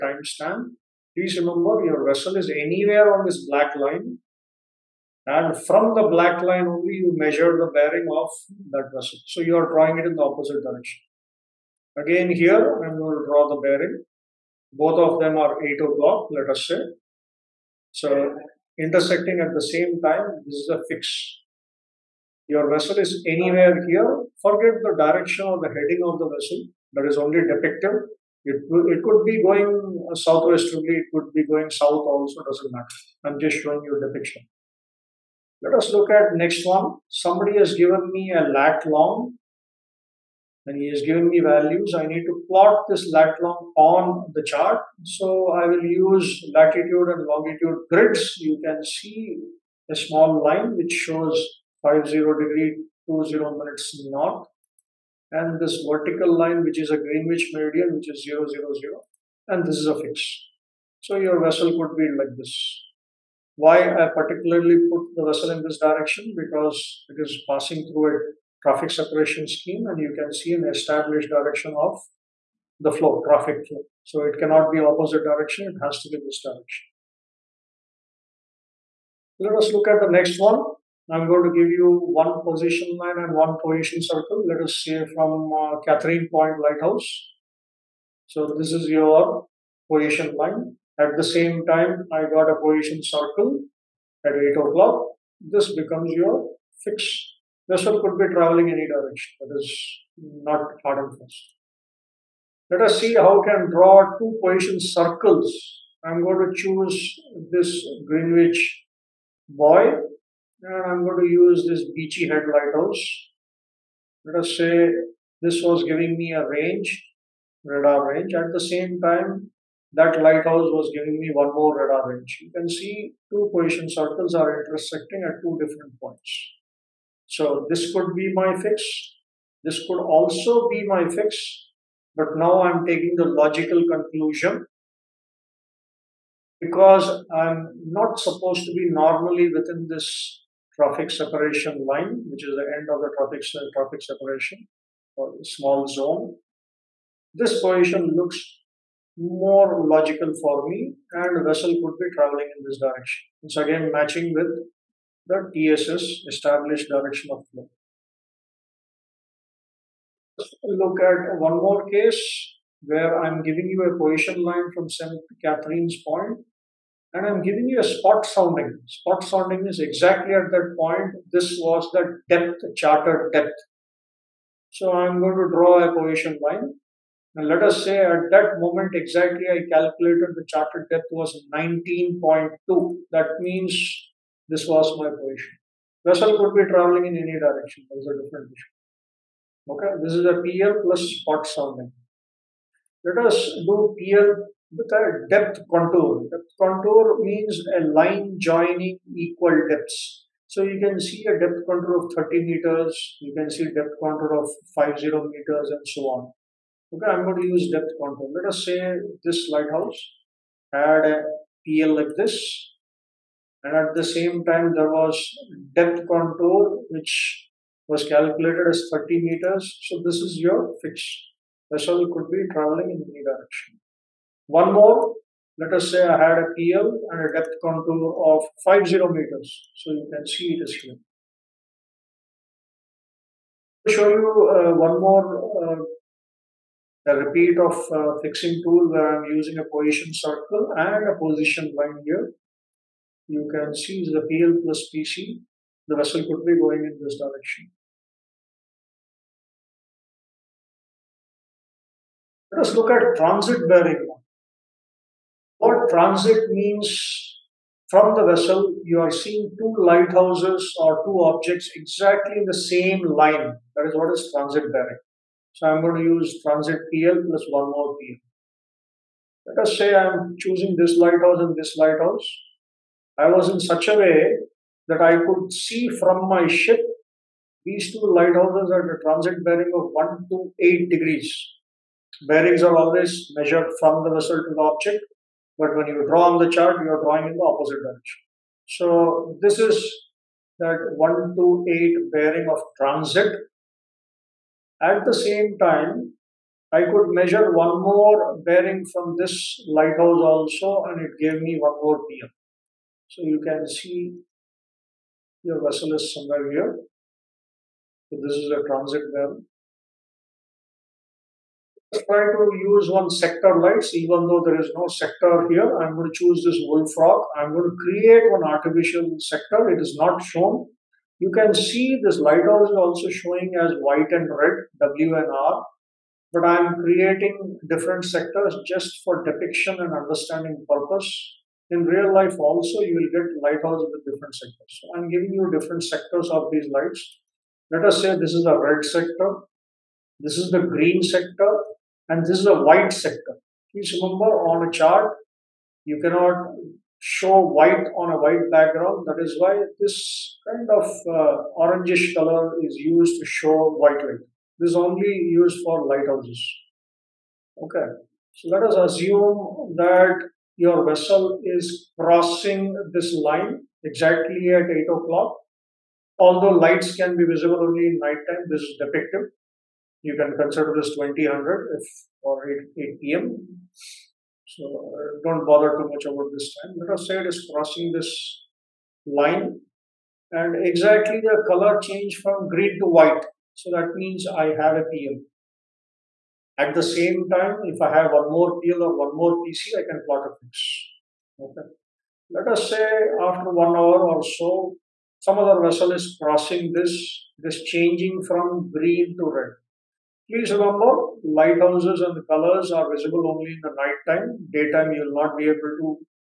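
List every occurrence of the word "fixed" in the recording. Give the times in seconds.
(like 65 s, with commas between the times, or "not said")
96 s.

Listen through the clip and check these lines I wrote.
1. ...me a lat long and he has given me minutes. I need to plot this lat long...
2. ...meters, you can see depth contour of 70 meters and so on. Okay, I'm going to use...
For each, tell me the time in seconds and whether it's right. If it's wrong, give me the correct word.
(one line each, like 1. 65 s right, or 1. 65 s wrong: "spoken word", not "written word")
1. 38 s wrong: "values", not "minutes"
2. 202 s wrong: "50", not "70".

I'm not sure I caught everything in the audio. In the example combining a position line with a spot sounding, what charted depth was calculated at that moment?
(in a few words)
19.2.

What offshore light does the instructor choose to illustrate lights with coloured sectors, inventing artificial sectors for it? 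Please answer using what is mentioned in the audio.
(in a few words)
Wolf Rock.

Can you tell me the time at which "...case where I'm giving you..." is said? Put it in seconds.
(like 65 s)
161 s.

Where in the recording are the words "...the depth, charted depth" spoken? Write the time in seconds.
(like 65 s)
171 s.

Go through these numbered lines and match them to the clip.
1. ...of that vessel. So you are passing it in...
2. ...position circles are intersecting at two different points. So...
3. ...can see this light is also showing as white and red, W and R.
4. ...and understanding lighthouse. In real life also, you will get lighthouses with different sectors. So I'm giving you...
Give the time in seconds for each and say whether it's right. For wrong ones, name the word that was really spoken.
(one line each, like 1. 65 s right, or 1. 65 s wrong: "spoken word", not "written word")
1. 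8 s wrong: "drawing", not "passing"
2. 123 s right
3. 321 s right
4. 329 s wrong: "purpose", not "lighthouse".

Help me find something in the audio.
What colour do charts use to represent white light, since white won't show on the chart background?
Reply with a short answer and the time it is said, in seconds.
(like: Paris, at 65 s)
orangish color, at 351 s.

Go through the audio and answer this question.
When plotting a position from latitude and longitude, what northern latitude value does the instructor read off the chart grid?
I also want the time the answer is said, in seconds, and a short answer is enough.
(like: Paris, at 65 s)
50 degrees 20 minutes north, at 51 s.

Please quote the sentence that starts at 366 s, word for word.
Although lights can be visible only in nighttime, this is depicted.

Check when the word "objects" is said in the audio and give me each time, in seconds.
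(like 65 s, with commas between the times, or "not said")
261 s, 284 s.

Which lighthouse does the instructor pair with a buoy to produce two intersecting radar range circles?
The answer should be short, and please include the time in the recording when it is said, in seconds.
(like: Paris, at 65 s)
Beachy Head lighthouse, at 111 s.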